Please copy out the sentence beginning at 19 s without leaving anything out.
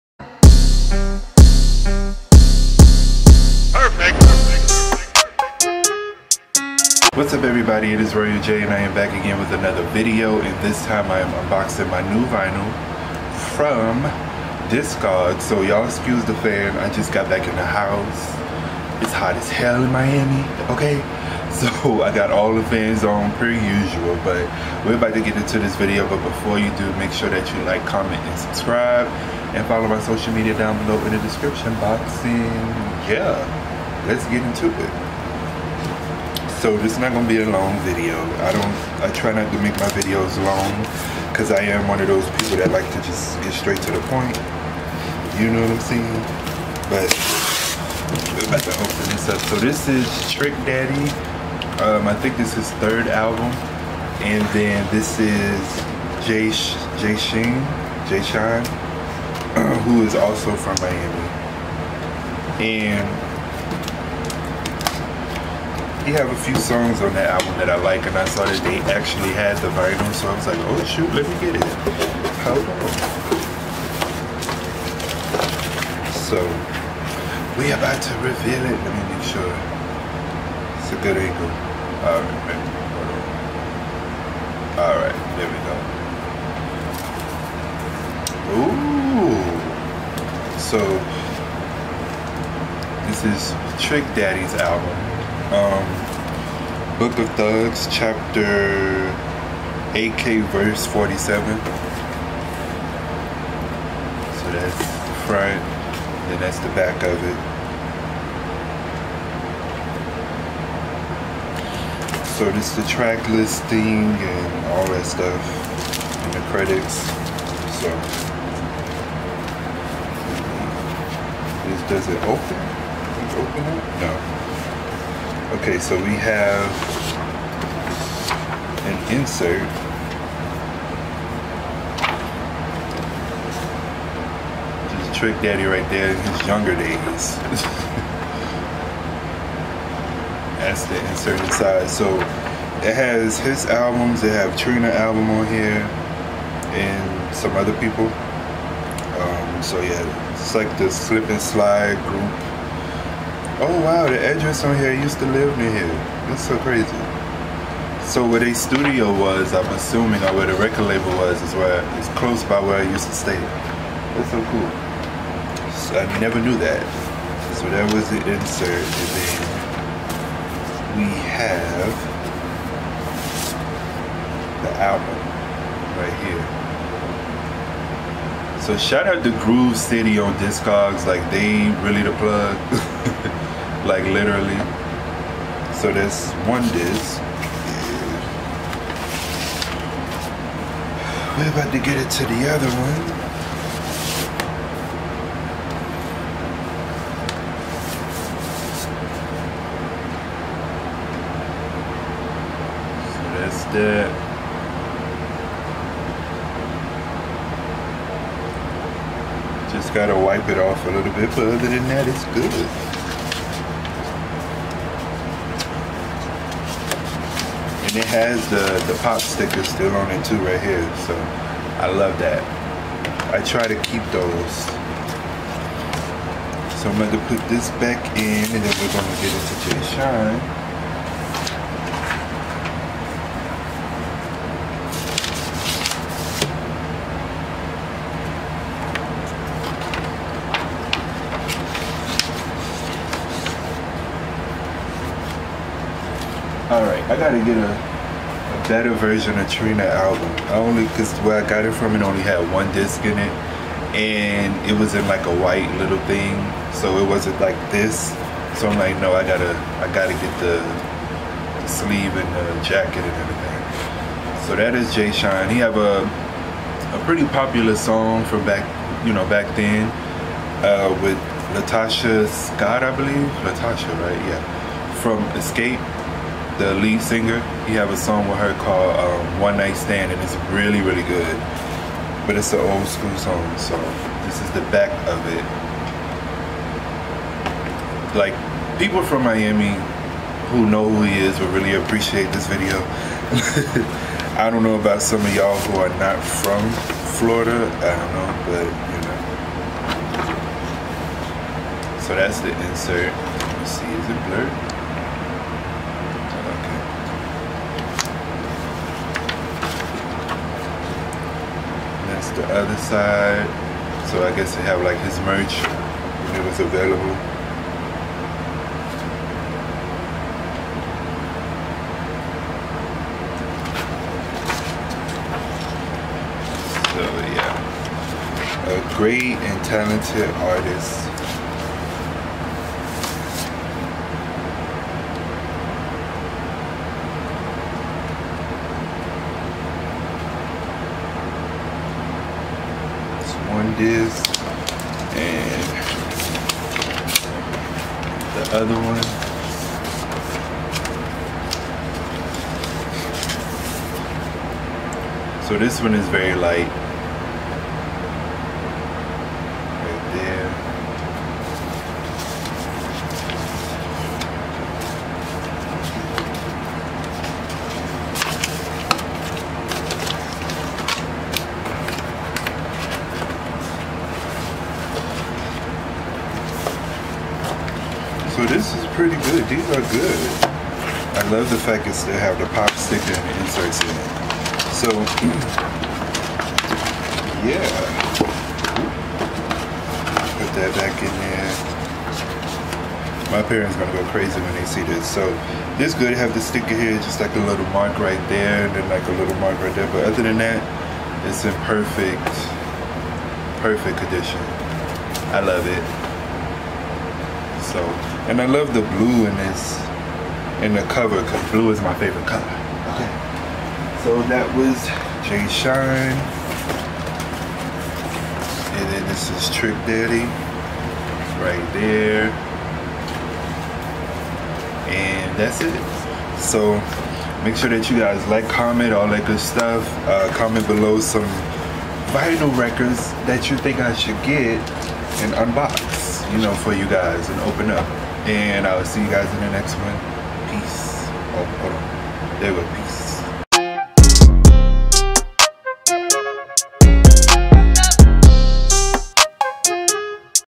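It's hot as hell in Miami, okay?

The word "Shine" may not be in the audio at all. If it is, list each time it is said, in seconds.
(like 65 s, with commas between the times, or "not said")
58 s, 229 s, 415 s.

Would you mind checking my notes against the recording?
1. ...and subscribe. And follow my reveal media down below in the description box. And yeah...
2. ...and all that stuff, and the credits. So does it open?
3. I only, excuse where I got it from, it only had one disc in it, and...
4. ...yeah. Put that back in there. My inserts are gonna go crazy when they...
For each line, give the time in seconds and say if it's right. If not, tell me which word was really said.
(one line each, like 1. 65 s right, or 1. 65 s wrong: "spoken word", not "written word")
1. 28 s wrong: "social", not "reveal"
2. 114 s right
3. 250 s wrong: "cause", not "excuse"
4. 387 s wrong: "parents", not "inserts".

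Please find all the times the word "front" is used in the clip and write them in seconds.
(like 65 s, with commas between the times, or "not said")
105 s.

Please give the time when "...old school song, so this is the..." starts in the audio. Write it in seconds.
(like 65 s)
282 s.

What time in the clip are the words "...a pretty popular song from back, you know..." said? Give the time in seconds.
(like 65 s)
266 s.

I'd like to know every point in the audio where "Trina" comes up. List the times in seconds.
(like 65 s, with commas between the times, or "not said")
144 s, 249 s.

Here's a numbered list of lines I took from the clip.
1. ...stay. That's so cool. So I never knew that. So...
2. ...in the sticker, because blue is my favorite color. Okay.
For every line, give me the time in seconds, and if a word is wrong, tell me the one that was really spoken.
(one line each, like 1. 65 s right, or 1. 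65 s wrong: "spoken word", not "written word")
1. 163 s right
2. 410 s wrong: "cover", not "sticker".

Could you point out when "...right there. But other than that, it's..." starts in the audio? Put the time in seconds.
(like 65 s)
399 s.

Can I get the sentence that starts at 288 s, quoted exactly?
Like, people from Miami who know who he is will really appreciate this video.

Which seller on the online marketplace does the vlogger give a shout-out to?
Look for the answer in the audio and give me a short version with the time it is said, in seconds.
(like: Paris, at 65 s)
Groove City, at 179 s.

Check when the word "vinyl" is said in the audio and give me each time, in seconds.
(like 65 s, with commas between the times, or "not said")
12 s, 69 s, 432 s.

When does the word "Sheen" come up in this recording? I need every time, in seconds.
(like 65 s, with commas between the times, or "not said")
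57 s.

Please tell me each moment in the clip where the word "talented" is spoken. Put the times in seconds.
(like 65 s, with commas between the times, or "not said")
329 s.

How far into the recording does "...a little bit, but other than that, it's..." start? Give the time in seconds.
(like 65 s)
210 s.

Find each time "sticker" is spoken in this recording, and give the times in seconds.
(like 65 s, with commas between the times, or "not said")
219 s, 382 s, 396 s.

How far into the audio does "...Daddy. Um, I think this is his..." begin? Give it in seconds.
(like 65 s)
50 s.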